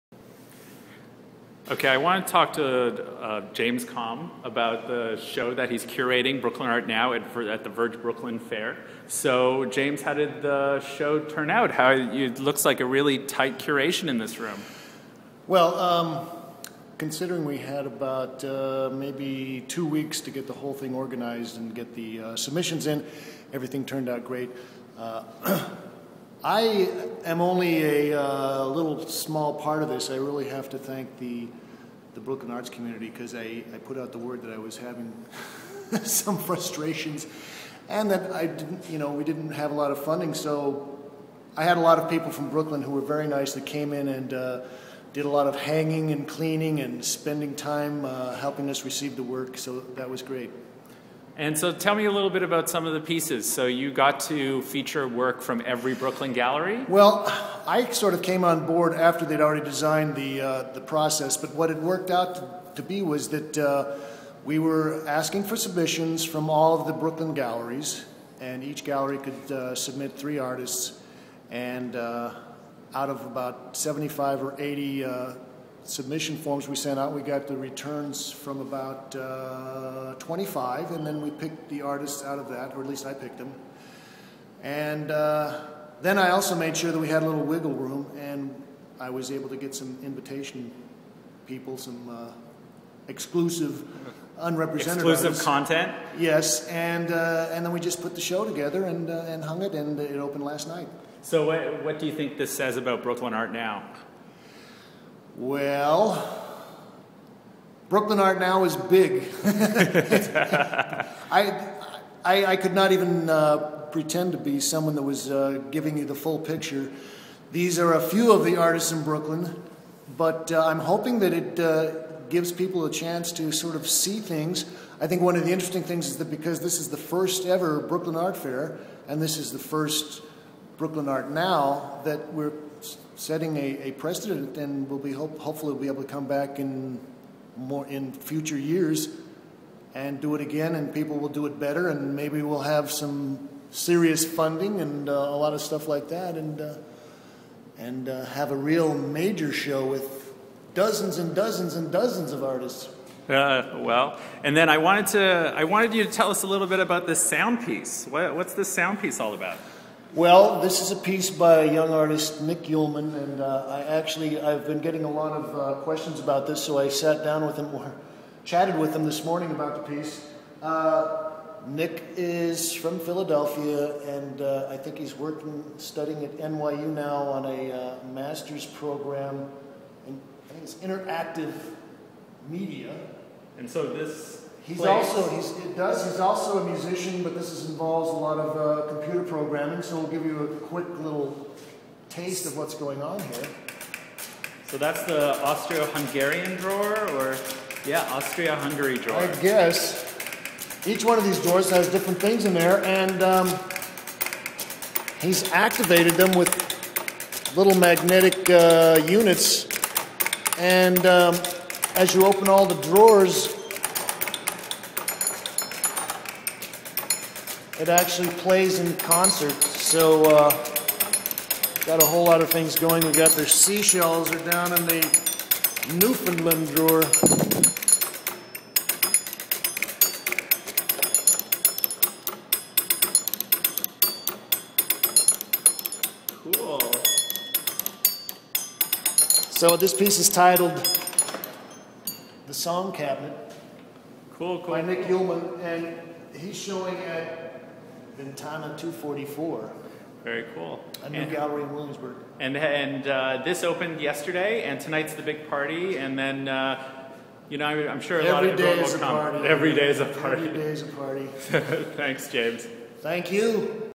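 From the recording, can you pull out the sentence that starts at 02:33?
Uh, well, and then I wanted to I wanted you to tell us a little bit about this sound piece.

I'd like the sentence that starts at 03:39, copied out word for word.
So uh, got a whole lot of things going.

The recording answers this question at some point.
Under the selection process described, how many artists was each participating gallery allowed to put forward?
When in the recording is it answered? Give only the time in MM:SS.
01:10.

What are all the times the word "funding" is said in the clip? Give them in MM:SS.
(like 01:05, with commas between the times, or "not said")
00:40, 02:24.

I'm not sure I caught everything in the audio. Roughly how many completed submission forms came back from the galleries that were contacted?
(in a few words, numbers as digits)
25.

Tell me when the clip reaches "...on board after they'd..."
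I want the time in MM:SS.
00:58.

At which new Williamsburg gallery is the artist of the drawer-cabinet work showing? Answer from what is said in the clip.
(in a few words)
Tana 244.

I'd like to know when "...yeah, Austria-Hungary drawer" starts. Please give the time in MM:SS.
03:17.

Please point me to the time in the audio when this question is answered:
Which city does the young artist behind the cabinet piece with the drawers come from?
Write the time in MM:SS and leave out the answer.
02:52.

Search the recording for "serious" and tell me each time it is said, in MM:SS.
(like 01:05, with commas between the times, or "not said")
02:23.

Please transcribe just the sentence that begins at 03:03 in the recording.
And so this He's also he's, it does.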